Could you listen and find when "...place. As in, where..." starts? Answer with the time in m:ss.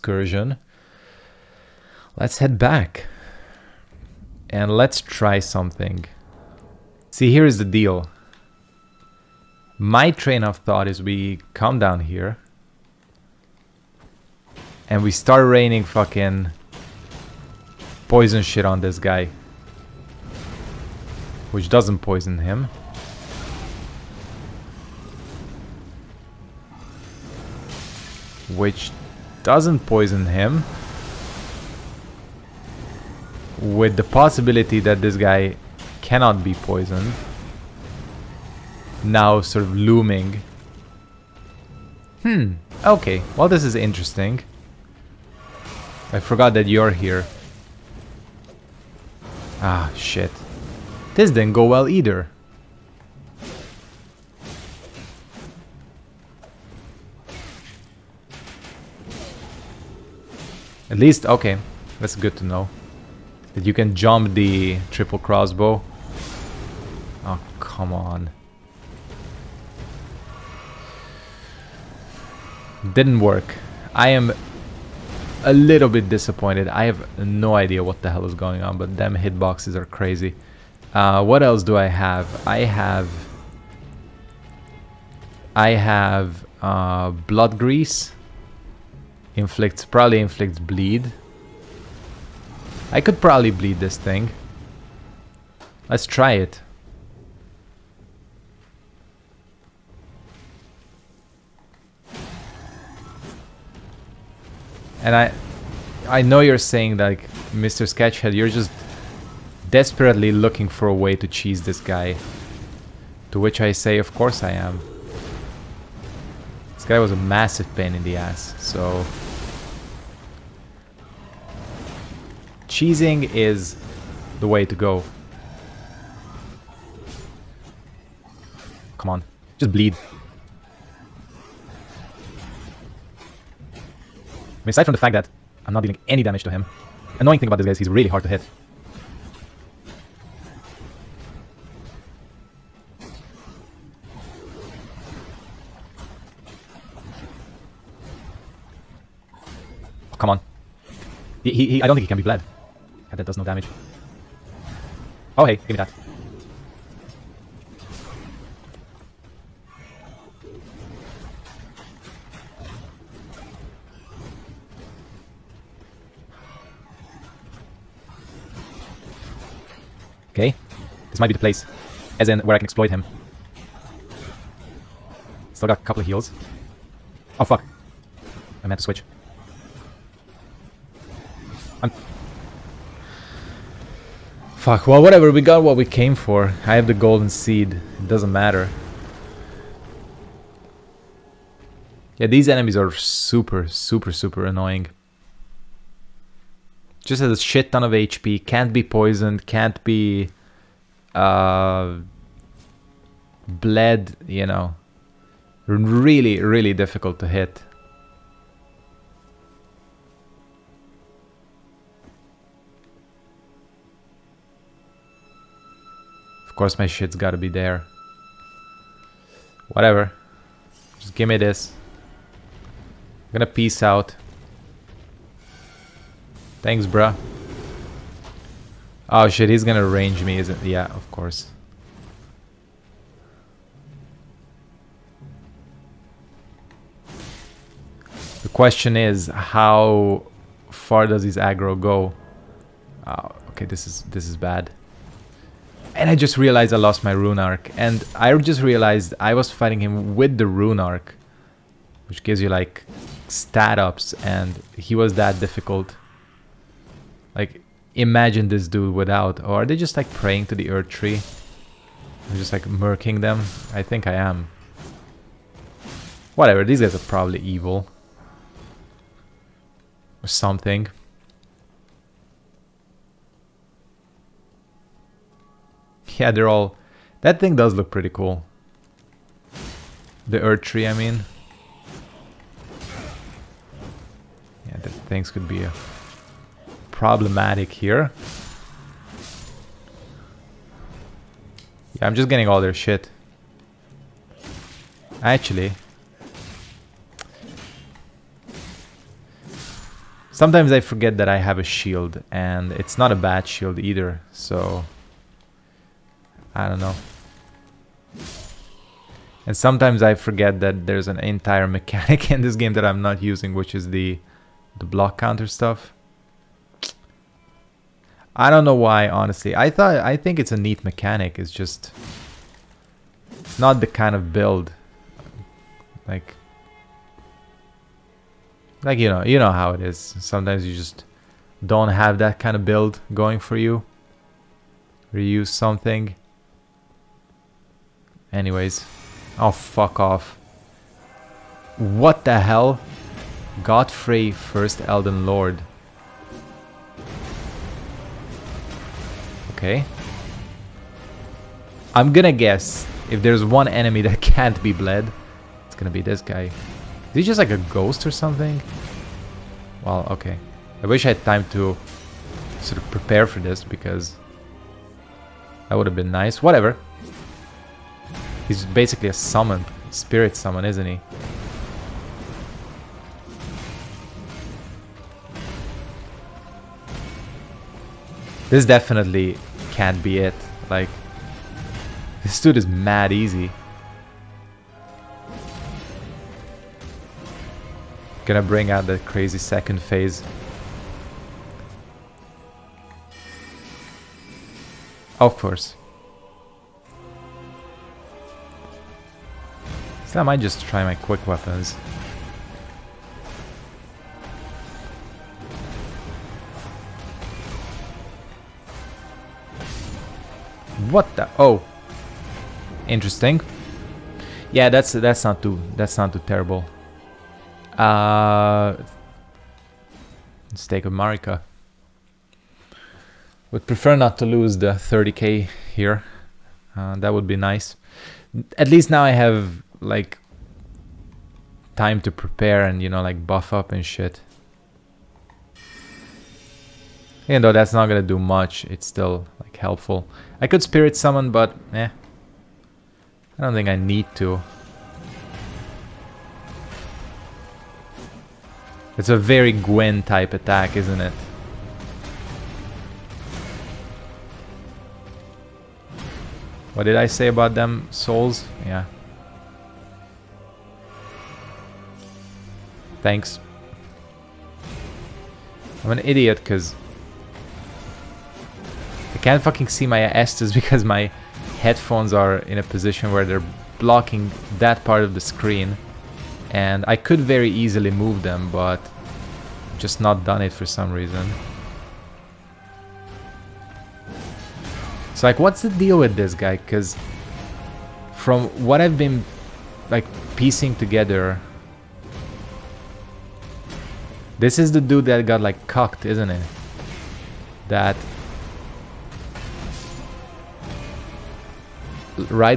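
2:51.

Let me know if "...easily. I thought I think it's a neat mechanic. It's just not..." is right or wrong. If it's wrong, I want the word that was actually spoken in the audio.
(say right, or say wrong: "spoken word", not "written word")
wrong: "honestly", not "easily".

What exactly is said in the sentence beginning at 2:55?
Still got a couple of heals.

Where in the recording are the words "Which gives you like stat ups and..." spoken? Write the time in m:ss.
4:12.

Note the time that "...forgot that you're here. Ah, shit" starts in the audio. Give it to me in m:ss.
0:46.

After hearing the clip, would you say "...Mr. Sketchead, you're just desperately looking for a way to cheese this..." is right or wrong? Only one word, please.
right.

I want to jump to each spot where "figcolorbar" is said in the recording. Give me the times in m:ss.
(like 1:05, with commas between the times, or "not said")
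not said.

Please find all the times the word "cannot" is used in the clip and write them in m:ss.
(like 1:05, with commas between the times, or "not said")
0:36.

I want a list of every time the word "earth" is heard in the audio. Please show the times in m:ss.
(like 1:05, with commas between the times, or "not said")
4:20, 4:40.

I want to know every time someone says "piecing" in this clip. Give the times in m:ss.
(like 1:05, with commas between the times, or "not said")
8:10.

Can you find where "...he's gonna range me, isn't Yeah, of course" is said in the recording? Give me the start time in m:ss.
3:49.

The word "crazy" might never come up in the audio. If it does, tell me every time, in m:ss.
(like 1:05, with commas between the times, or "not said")
1:19, 6:29.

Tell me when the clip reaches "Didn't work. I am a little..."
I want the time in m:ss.
1:12.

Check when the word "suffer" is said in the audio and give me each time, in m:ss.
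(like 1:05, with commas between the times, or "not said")
not said.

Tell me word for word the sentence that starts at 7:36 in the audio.
What did I say about them souls?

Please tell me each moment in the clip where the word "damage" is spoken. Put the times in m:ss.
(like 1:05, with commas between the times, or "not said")
2:16, 2:33.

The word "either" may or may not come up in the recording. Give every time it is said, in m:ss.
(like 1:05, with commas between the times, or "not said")
0:51, 5:03.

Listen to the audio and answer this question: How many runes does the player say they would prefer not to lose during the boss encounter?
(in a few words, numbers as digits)
30k.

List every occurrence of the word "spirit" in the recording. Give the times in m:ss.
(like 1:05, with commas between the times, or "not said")
6:09, 7:20.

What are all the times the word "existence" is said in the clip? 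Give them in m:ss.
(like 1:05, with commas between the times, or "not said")
not said.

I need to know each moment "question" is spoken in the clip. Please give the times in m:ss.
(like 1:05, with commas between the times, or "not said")
3:58.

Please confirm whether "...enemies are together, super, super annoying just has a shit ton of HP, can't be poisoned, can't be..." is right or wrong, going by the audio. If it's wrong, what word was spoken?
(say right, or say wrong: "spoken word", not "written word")
wrong: "super", not "together".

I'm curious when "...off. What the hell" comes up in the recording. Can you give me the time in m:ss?
5:39.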